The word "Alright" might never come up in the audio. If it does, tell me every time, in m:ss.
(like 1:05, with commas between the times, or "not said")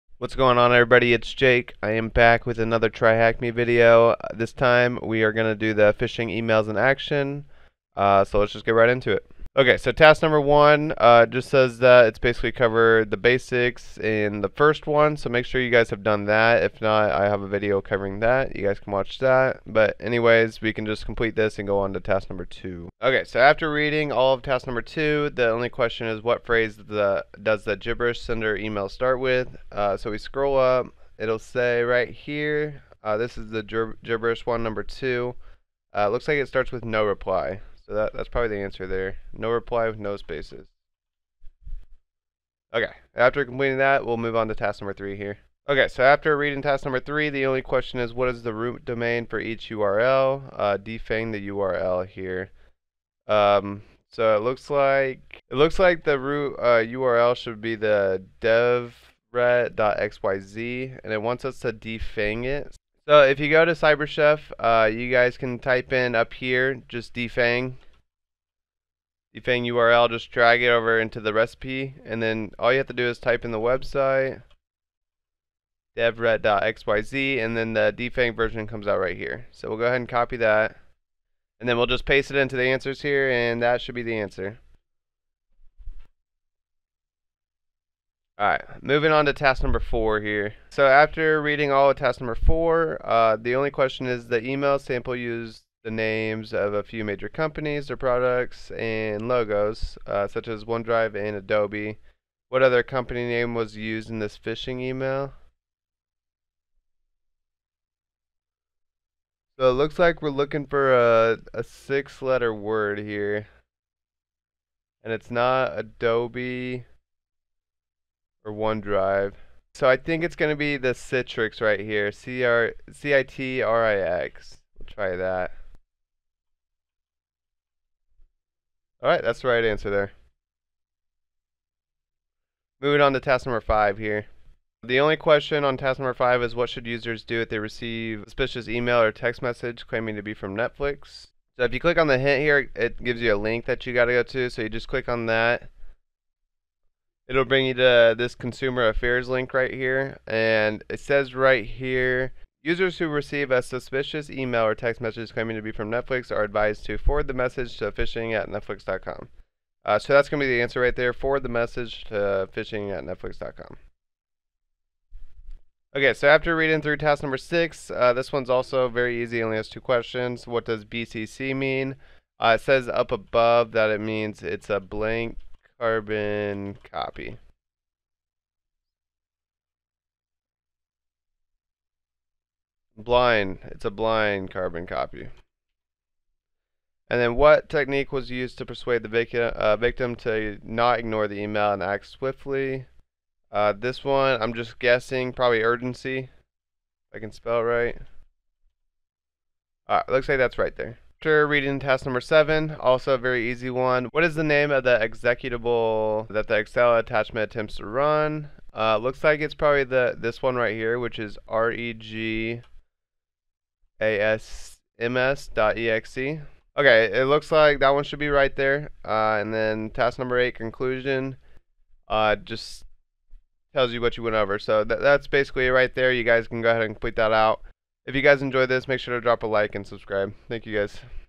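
1:28, 3:19.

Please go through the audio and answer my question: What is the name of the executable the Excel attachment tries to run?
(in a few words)
regASMS.exe.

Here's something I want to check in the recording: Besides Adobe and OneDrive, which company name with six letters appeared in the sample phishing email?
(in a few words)
Citrix.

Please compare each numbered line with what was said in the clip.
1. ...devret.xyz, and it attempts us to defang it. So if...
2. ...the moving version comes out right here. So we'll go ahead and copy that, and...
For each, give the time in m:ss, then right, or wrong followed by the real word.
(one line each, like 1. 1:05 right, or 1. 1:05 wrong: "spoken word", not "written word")
1. 0:58 wrong: "wants", not "attempts"
2. 1:17 wrong: "defang", not "moving".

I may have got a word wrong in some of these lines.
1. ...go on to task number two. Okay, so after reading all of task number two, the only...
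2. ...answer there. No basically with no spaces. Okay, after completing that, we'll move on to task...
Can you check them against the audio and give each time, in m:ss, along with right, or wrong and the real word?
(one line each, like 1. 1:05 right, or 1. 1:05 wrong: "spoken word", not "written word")
1. 0:21 right
2. 0:38 wrong: "reply", not "basically".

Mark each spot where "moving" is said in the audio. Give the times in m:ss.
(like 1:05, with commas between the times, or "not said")
1:28, 2:12.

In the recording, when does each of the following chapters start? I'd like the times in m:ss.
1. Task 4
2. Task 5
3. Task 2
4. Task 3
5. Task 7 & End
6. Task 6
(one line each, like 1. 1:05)
1. 1:26
2. 2:11
3. 0:23
4. 0:43
5. 3:21
6. 2:46.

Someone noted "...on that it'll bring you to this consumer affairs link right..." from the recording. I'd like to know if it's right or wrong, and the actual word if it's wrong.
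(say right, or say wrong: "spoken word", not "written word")
right.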